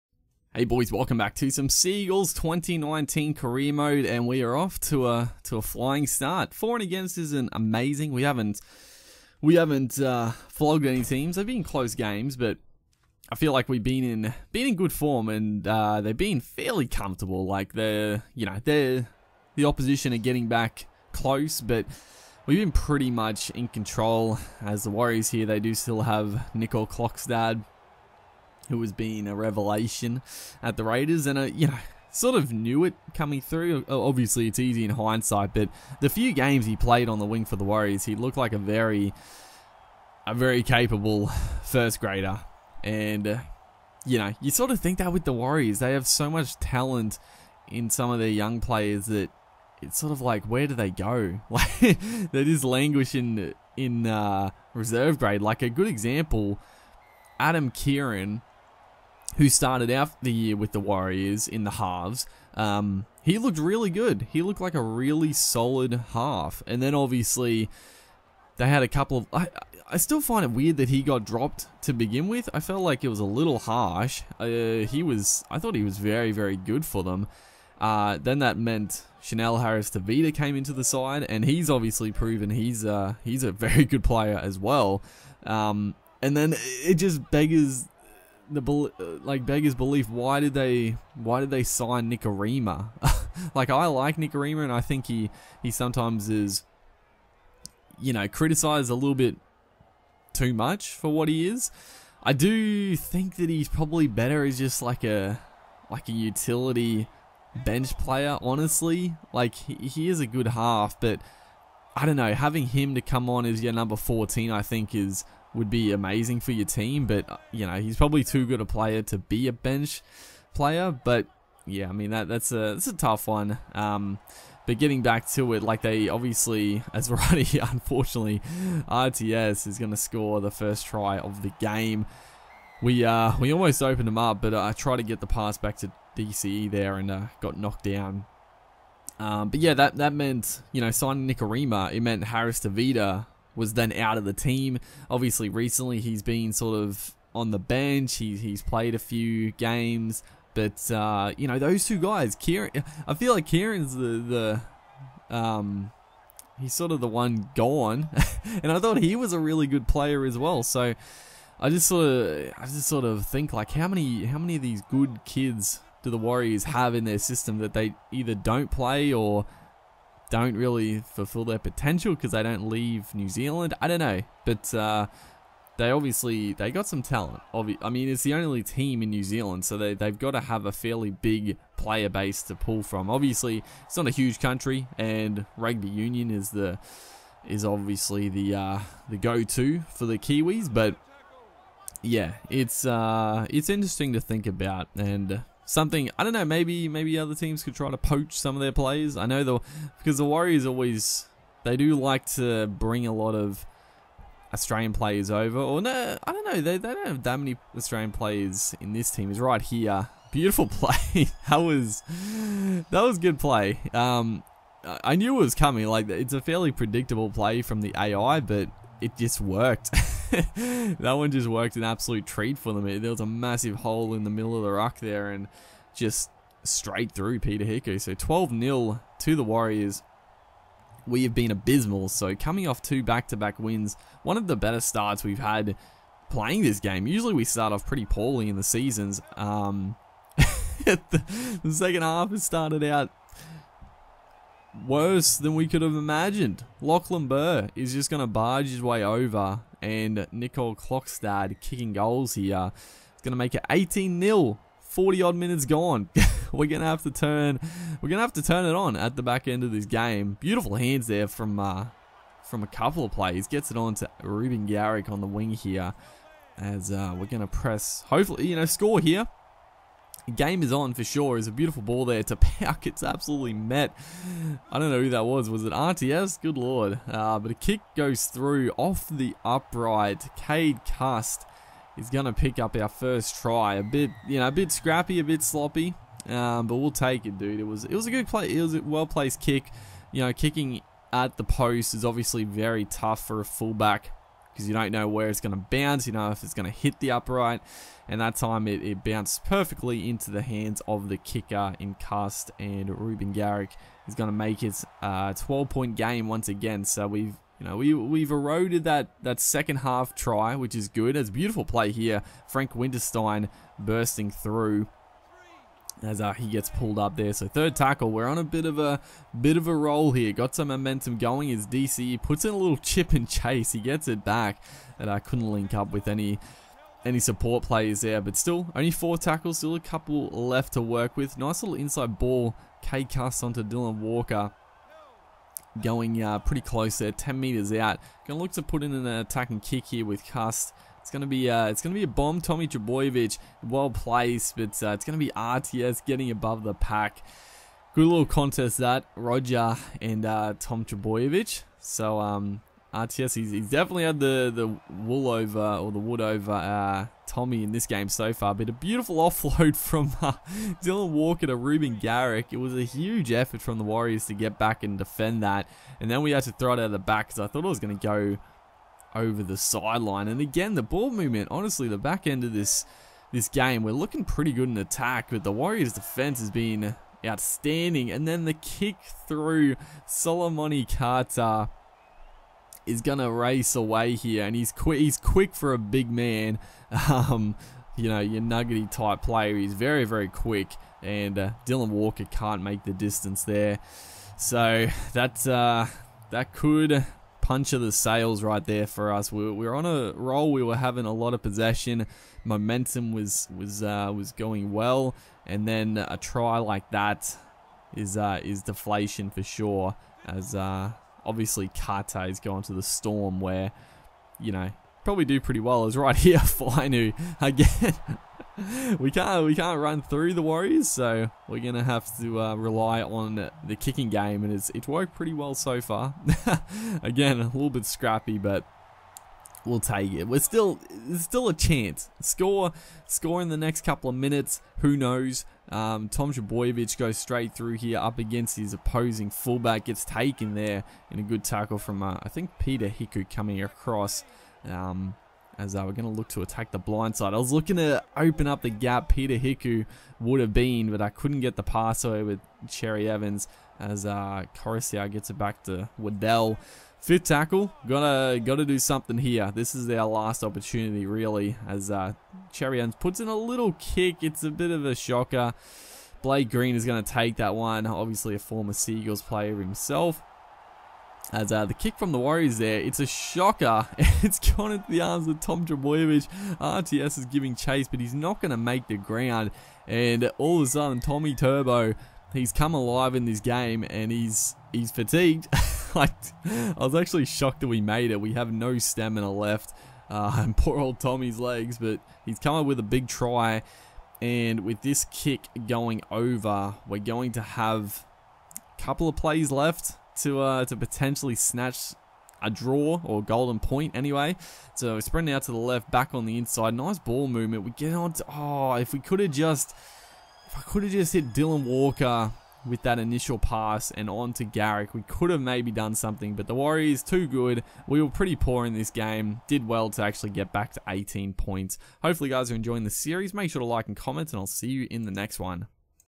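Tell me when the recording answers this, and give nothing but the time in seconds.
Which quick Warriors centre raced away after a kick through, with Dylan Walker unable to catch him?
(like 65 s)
380 s.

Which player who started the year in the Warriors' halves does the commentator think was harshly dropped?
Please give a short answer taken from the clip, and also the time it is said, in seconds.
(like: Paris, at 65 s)
Adam Keighran, at 57 s.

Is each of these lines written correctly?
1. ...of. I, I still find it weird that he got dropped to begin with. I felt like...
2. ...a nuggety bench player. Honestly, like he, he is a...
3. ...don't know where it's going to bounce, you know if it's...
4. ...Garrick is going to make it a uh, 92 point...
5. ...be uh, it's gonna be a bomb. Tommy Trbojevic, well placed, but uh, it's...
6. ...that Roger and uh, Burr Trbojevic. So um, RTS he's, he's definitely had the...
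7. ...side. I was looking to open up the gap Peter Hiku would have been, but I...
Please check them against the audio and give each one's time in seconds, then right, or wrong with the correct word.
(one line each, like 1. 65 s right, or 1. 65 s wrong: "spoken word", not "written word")
1. 69 s right
2. 106 s wrong: "utility", not "nuggety"
3. 294 s right
4. 303 s wrong: "12", not "92"
5. 341 s right
6. 348 s wrong: "Tom", not "Burr"
7. 447 s right.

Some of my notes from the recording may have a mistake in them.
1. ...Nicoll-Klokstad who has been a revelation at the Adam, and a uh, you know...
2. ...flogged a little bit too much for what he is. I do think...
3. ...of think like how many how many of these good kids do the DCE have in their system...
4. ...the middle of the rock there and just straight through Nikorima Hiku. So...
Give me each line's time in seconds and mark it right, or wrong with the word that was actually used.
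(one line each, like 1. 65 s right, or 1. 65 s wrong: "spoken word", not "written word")
1. 26 s wrong: "Raiders", not "Adam"
2. 98 s wrong: "criticized", not "flogged"
3. 163 s wrong: "Warriors", not "DCE"
4. 224 s wrong: "Peter", not "Nikorima".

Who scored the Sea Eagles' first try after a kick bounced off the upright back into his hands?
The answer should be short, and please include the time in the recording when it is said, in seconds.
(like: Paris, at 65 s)
Cade Cust, at 280 s.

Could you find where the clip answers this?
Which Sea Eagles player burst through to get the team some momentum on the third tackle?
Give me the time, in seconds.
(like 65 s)
312 s.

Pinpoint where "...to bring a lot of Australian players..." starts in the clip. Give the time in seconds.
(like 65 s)
202 s.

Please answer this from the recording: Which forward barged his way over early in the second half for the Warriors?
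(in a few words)
Lachlan Burr.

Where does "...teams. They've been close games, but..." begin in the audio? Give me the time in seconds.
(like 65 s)
11 s.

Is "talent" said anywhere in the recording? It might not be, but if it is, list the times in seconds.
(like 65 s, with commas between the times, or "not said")
46 s, 177 s.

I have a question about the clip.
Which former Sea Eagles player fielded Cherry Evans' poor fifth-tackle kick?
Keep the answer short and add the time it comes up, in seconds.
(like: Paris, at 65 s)
Blake Green, at 466 s.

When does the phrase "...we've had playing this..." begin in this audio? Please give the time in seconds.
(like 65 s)
235 s.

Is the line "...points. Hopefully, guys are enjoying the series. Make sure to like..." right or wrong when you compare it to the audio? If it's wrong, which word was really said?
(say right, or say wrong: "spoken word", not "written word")
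right.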